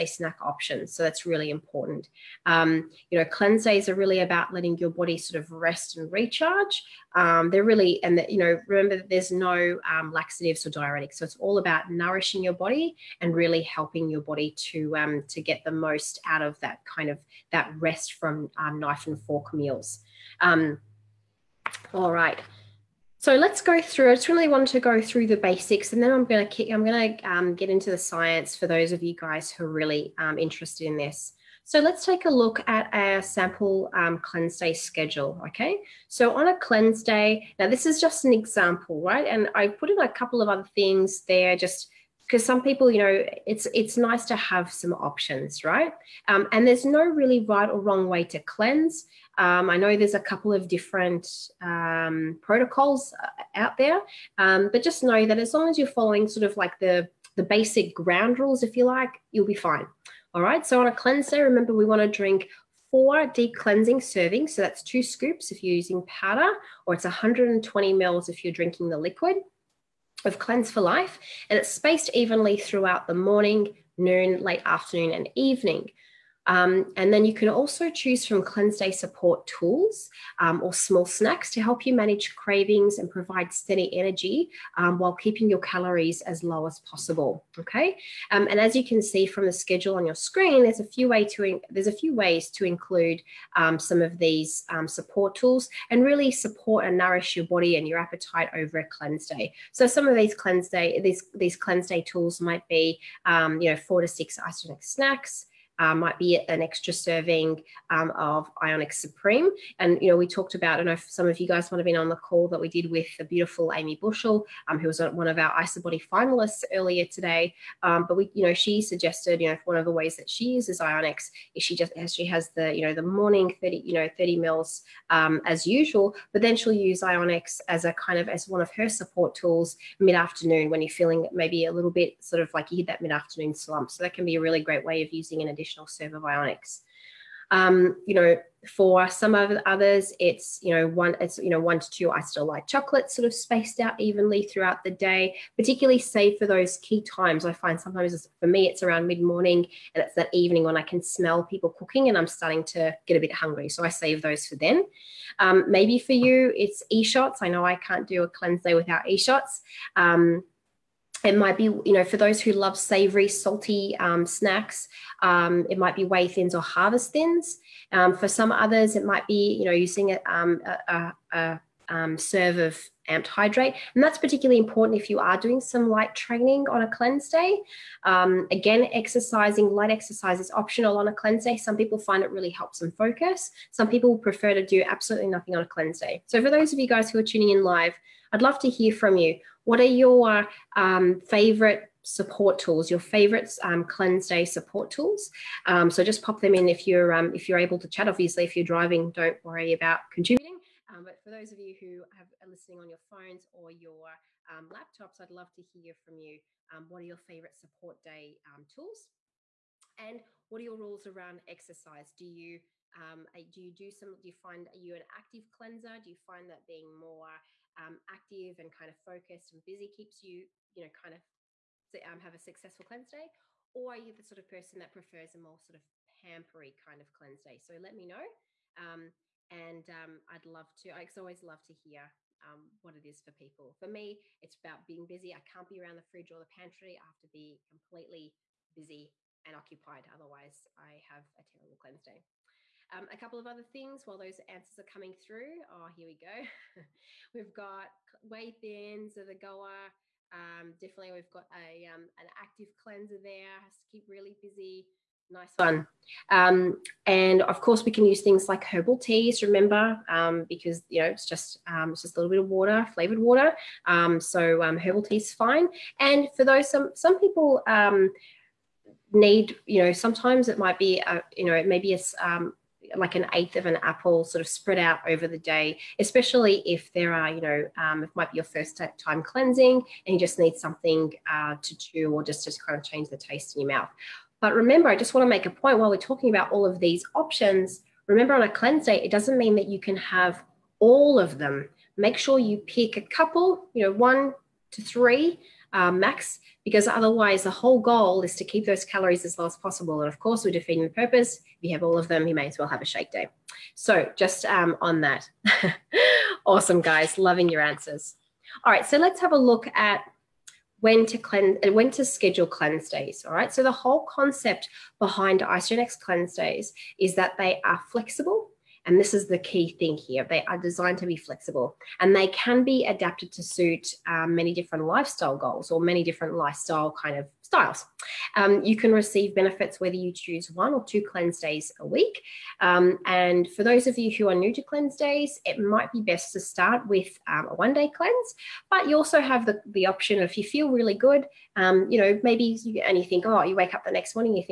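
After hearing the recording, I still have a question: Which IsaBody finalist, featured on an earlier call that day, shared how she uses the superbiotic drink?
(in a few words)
Amy Bushell.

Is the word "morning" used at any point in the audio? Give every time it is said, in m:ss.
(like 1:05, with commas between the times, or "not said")
1:13, 2:03, 2:29.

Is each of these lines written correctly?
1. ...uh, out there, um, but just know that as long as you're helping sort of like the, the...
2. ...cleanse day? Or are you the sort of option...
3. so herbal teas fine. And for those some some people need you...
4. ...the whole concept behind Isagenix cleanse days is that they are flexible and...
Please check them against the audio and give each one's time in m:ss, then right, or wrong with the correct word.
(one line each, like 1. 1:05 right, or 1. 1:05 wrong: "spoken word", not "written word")
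1. 0:53 wrong: "following", not "helping"
2. 3:42 wrong: "person", not "option"
3. 4:24 right
4. 5:13 right.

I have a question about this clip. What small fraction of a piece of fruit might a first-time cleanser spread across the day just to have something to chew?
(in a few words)
an eighth of an apple.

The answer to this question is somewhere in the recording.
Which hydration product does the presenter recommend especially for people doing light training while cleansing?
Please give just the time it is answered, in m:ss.
2:53.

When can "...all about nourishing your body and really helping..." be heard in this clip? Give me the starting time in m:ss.
0:11.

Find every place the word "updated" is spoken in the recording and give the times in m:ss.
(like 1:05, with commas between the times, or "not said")
not said.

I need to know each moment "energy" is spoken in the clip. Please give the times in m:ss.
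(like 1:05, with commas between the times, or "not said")
1:23.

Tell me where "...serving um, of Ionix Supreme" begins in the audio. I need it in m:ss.
1:46.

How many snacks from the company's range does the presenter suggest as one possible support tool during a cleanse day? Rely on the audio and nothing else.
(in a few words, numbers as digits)
4 to 6.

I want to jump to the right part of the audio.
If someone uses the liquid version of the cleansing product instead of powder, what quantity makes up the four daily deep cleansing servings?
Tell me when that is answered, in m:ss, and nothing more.
1:07.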